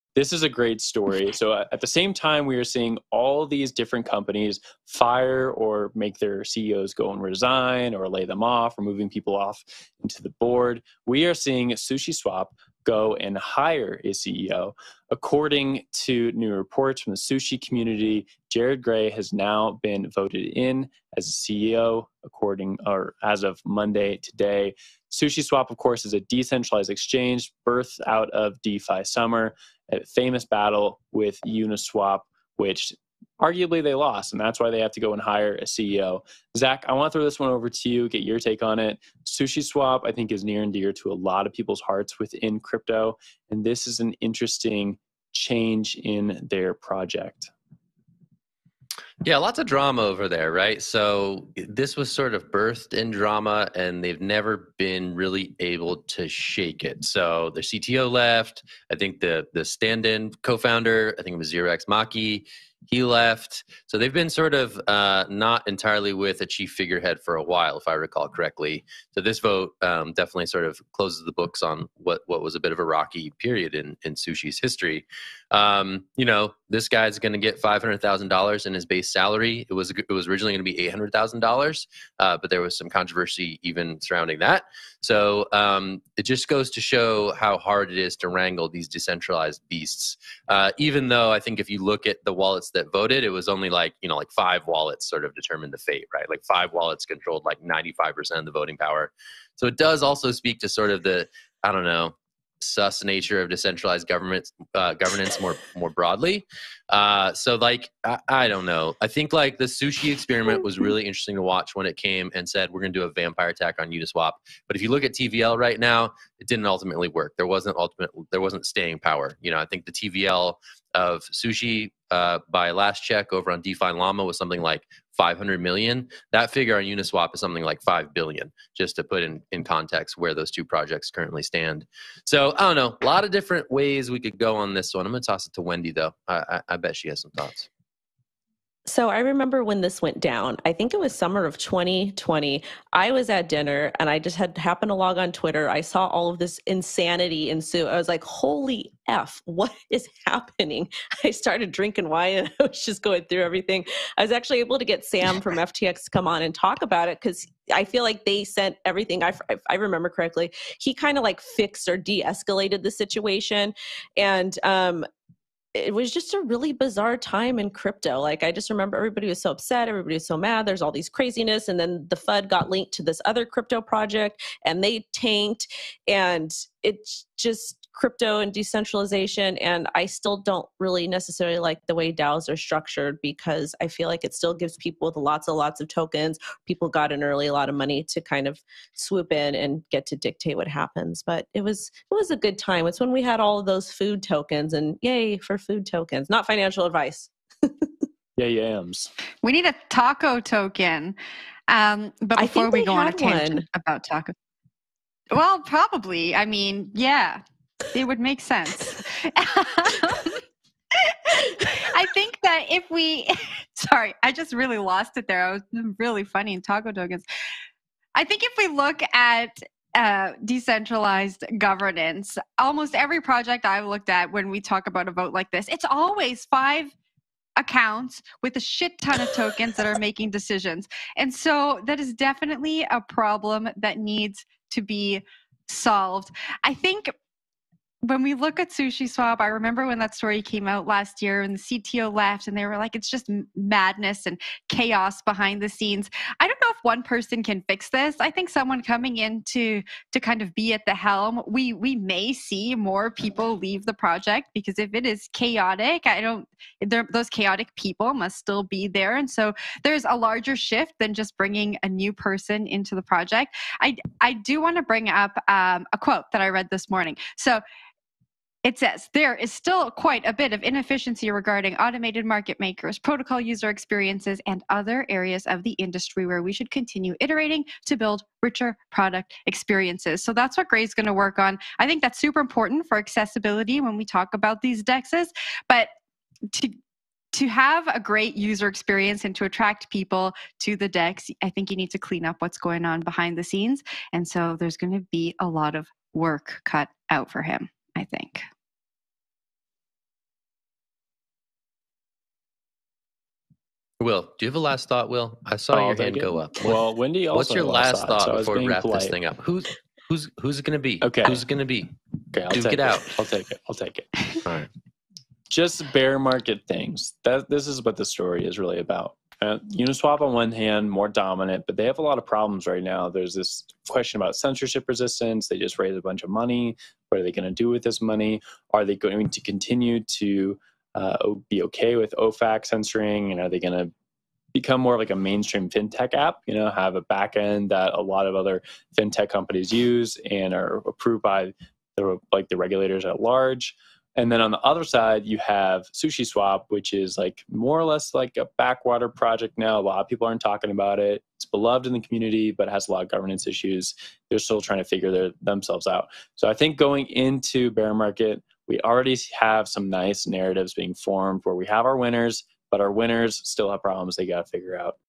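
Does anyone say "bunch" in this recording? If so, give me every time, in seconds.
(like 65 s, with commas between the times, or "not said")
326 s.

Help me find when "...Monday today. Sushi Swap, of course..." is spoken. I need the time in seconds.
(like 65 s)
23 s.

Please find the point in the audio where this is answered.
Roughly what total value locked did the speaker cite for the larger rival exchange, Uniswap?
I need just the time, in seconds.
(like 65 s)
127 s.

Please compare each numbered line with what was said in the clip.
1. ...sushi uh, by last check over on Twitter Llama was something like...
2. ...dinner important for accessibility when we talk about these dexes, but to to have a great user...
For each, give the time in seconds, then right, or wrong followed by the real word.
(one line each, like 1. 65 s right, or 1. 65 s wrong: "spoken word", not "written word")
1. 121 s wrong: "DeFi", not "Twitter"
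2. 282 s wrong: "super", not "dinner".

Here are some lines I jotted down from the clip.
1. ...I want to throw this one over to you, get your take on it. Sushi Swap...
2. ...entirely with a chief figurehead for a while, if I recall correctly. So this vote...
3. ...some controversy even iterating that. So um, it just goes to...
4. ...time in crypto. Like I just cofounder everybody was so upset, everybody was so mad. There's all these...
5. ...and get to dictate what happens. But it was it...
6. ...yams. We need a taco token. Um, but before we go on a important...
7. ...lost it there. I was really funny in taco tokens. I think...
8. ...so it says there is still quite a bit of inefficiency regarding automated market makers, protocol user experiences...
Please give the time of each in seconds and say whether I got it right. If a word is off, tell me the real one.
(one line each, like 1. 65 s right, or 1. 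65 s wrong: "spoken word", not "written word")
1. 36 s right
2. 65 s right
3. 82 s wrong: "surrounding", not "iterating"
4. 167 s wrong: "remember", not "cofounder"
5. 189 s right
6. 198 s wrong: "tangent", not "important"
7. 214 s right
8. 267 s right.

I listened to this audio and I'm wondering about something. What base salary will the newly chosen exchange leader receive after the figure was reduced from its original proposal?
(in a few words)
$500,000.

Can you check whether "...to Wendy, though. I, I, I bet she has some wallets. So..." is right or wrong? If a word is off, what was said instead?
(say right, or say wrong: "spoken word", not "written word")
wrong: "thoughts", not "wallets".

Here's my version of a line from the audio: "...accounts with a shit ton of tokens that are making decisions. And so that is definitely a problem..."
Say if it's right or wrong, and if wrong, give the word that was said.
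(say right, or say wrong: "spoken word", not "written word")
right.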